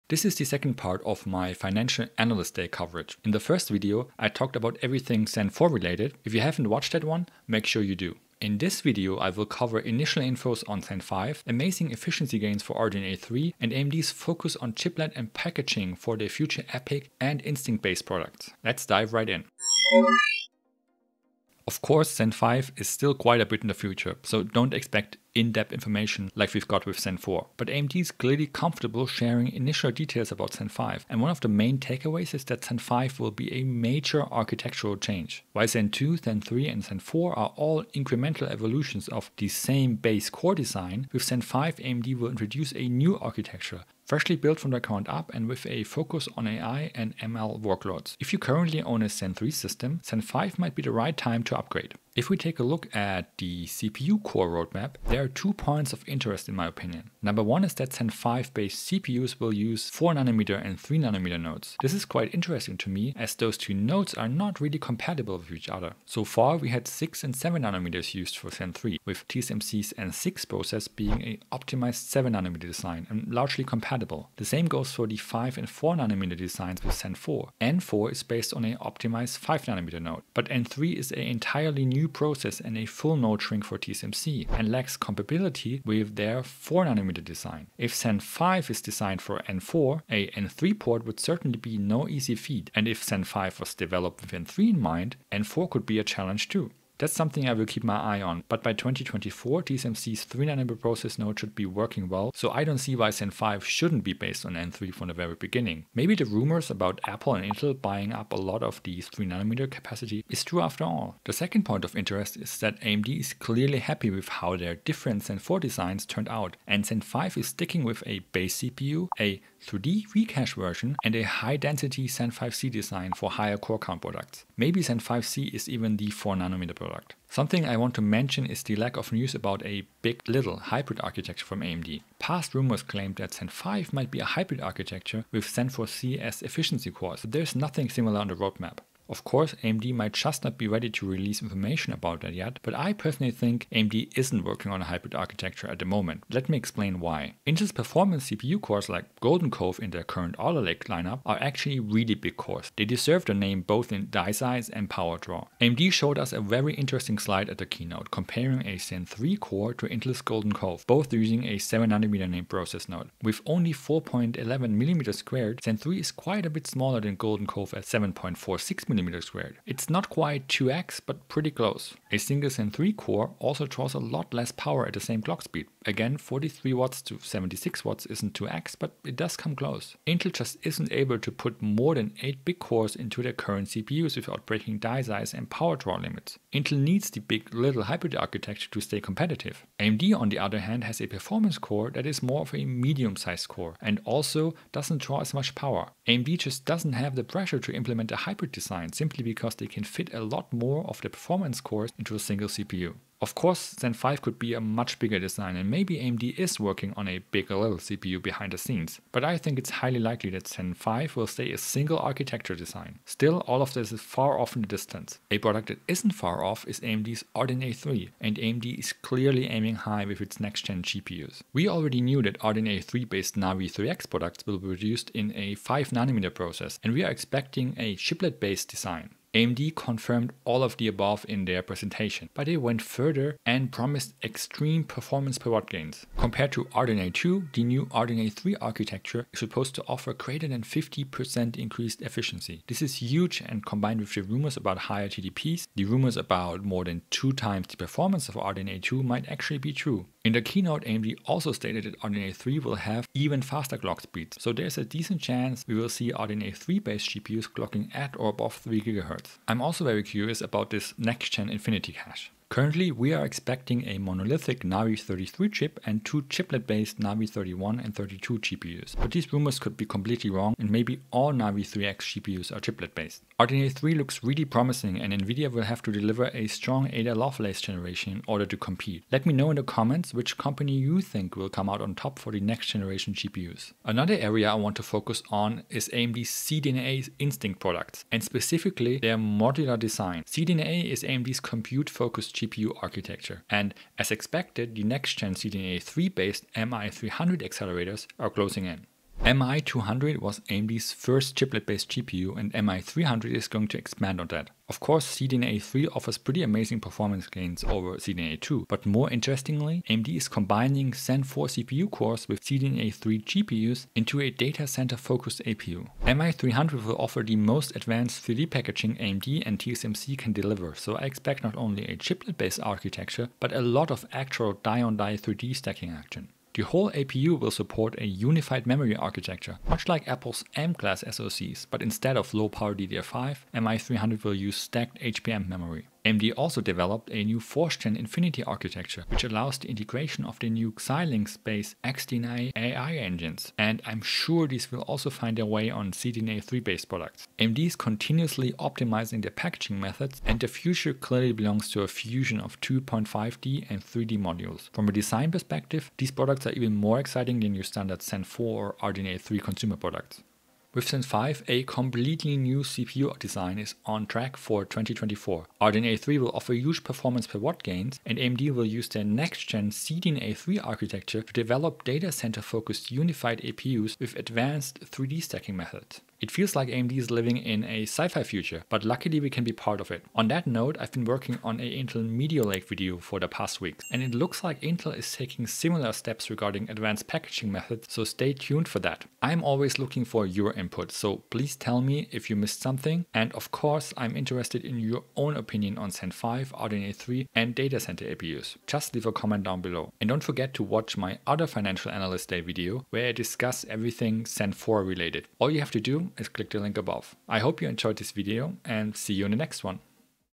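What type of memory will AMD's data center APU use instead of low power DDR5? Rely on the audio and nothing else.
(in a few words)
stacked HBM memory.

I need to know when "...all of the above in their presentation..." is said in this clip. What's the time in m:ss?
3:50.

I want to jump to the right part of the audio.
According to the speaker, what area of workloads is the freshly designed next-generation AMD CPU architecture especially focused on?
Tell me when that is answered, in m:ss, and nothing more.
0:46.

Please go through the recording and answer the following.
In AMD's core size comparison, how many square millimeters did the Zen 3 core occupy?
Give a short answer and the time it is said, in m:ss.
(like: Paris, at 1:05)
4.11, at 2:43.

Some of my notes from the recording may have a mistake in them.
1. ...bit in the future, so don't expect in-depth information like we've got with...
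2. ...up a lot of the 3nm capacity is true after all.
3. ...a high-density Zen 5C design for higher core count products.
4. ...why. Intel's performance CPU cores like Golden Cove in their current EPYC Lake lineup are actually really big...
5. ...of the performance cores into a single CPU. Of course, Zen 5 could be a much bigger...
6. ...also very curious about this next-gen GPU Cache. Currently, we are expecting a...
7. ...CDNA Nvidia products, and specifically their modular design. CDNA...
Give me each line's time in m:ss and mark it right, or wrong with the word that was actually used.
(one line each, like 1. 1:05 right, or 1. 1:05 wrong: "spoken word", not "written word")
1. 0:23 right
2. 1:48 right
3. 2:01 right
4. 2:27 wrong: "Alder", not "EPYC"
5. 3:20 right
6. 4:19 wrong: "Infinity", not "GPU"
7. 4:46 wrong: "Instinct", not "Nvidia".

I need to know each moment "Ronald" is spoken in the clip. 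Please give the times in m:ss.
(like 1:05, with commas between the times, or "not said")
not said.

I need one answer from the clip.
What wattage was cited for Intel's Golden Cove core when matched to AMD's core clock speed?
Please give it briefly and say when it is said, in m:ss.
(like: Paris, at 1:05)
76, at 2:57.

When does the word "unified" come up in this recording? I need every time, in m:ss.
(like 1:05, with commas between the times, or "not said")
5:28, 6:12.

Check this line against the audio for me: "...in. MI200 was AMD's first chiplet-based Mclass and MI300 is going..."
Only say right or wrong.
wrong.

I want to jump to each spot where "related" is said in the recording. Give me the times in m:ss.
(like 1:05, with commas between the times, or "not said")
0:05, 6:44.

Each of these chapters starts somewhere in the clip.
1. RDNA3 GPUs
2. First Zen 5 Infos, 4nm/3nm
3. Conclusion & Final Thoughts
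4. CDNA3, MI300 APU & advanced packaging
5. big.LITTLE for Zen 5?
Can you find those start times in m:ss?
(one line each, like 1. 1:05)
1. 3:40
2. 0:21
3. 6:00
4. 4:43
5. 2:07.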